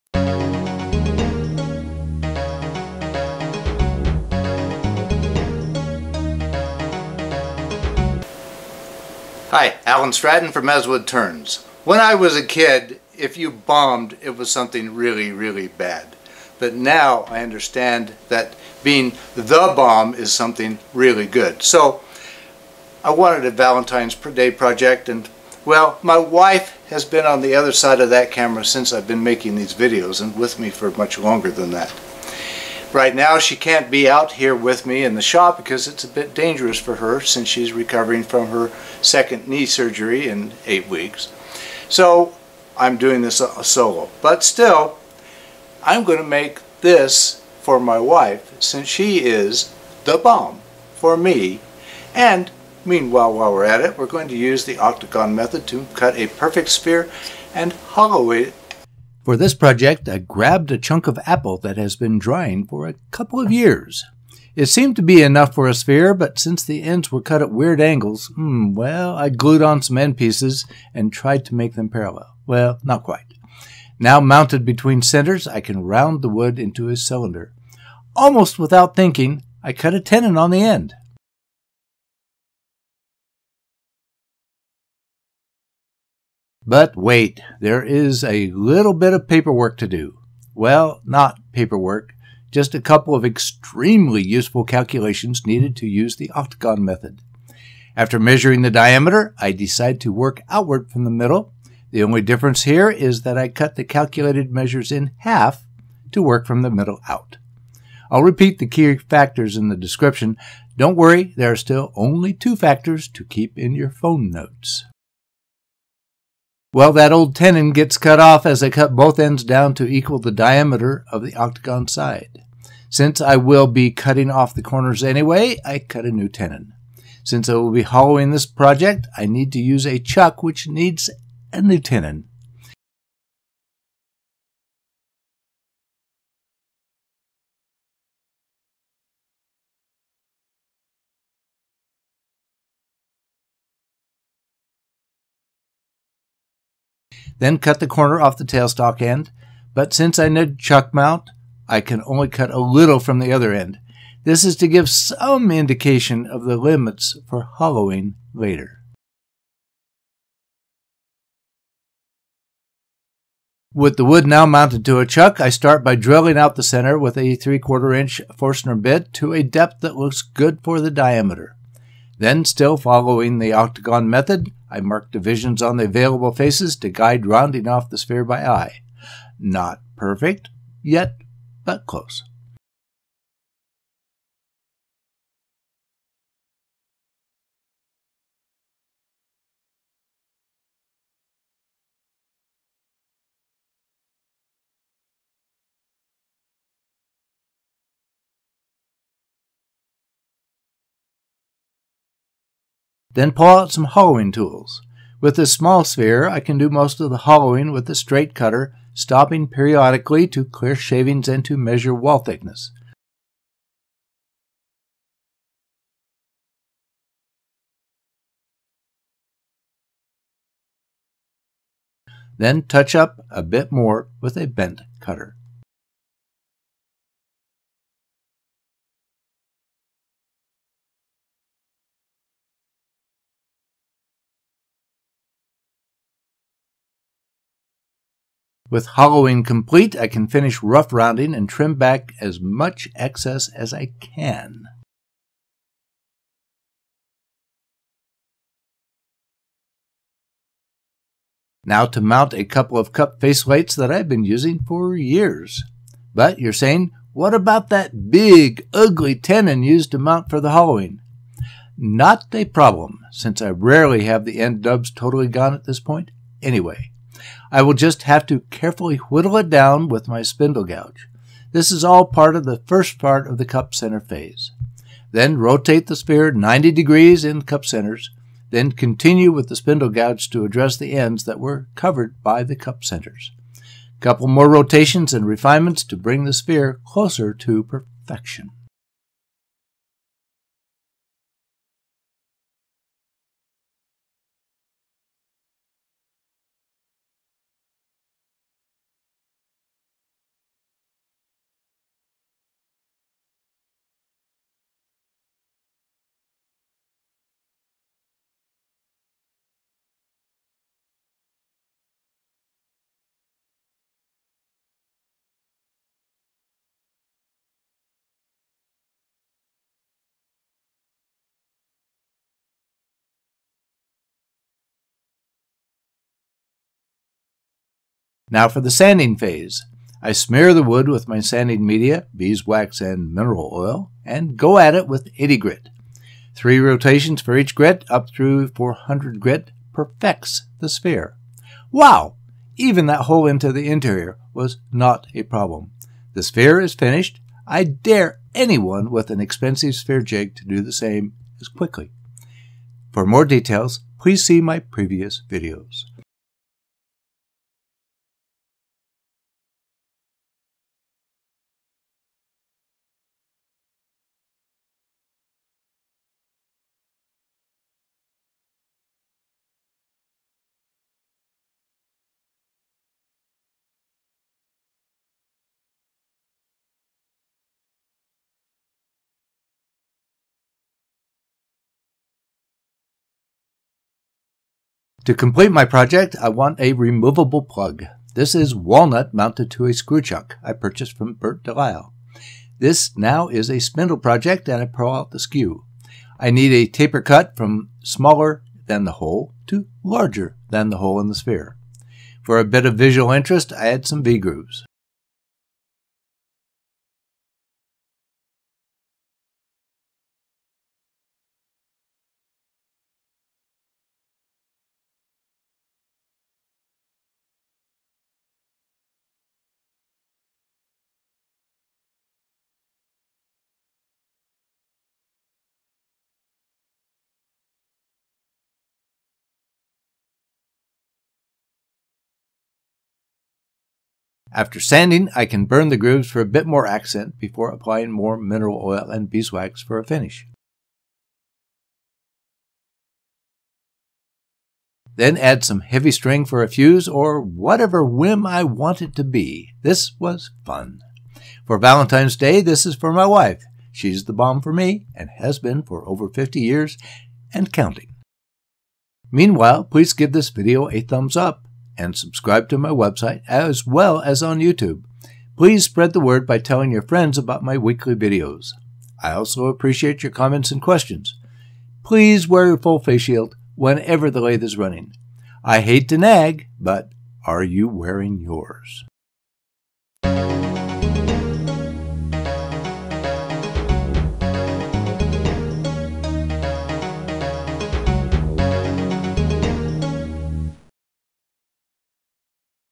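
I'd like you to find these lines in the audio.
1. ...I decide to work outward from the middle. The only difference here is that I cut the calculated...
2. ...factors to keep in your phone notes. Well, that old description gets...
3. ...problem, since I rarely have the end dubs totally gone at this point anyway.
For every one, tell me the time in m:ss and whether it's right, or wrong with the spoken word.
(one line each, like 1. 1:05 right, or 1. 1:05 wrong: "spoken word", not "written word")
1. 1:39 right
2. 1:52 wrong: "tenon", not "description"
3. 4:22 right.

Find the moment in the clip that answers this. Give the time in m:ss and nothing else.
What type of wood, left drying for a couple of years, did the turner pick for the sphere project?
1:01.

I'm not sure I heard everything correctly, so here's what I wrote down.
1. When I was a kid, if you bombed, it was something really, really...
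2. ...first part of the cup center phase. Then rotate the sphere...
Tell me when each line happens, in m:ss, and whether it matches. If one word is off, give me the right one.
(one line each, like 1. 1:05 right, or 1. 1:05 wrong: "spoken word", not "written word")
1. 0:11 right
2. 4:32 right.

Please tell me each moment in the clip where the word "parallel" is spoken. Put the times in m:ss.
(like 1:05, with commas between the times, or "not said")
1:11.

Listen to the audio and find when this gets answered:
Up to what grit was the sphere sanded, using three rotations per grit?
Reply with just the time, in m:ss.
5:38.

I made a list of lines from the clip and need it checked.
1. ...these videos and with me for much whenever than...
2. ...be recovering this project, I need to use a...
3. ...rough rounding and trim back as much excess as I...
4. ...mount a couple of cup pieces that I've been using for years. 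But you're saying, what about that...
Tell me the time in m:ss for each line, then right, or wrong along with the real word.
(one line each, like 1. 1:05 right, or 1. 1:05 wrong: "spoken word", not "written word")
1. 0:29 wrong: "longer", not "whenever"
2. 2:07 wrong: "hollowing", not "recovering"
3. 4:00 right
4. 4:11 wrong: "faceplates", not "pieces".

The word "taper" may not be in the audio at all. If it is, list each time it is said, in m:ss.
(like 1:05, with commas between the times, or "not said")
6:36.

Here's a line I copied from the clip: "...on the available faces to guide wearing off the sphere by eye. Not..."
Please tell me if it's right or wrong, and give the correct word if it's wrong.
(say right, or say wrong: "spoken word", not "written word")
wrong: "rounding", not "wearing".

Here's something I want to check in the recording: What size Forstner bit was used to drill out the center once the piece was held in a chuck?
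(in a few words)
3/4 inch.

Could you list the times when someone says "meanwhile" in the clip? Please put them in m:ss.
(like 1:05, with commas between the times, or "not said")
0:52, 7:39.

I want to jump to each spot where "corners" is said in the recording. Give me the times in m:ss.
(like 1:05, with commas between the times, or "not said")
2:04, 2:27.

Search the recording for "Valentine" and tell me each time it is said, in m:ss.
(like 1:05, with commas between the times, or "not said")
0:23, 7:31.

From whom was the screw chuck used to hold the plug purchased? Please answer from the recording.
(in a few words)
Bert Delisle.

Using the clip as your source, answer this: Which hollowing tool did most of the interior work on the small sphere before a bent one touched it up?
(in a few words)
Straight cutter.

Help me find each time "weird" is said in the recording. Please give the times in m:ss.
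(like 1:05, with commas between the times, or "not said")
1:07.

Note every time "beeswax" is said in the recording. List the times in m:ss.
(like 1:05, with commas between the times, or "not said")
5:32, 7:19.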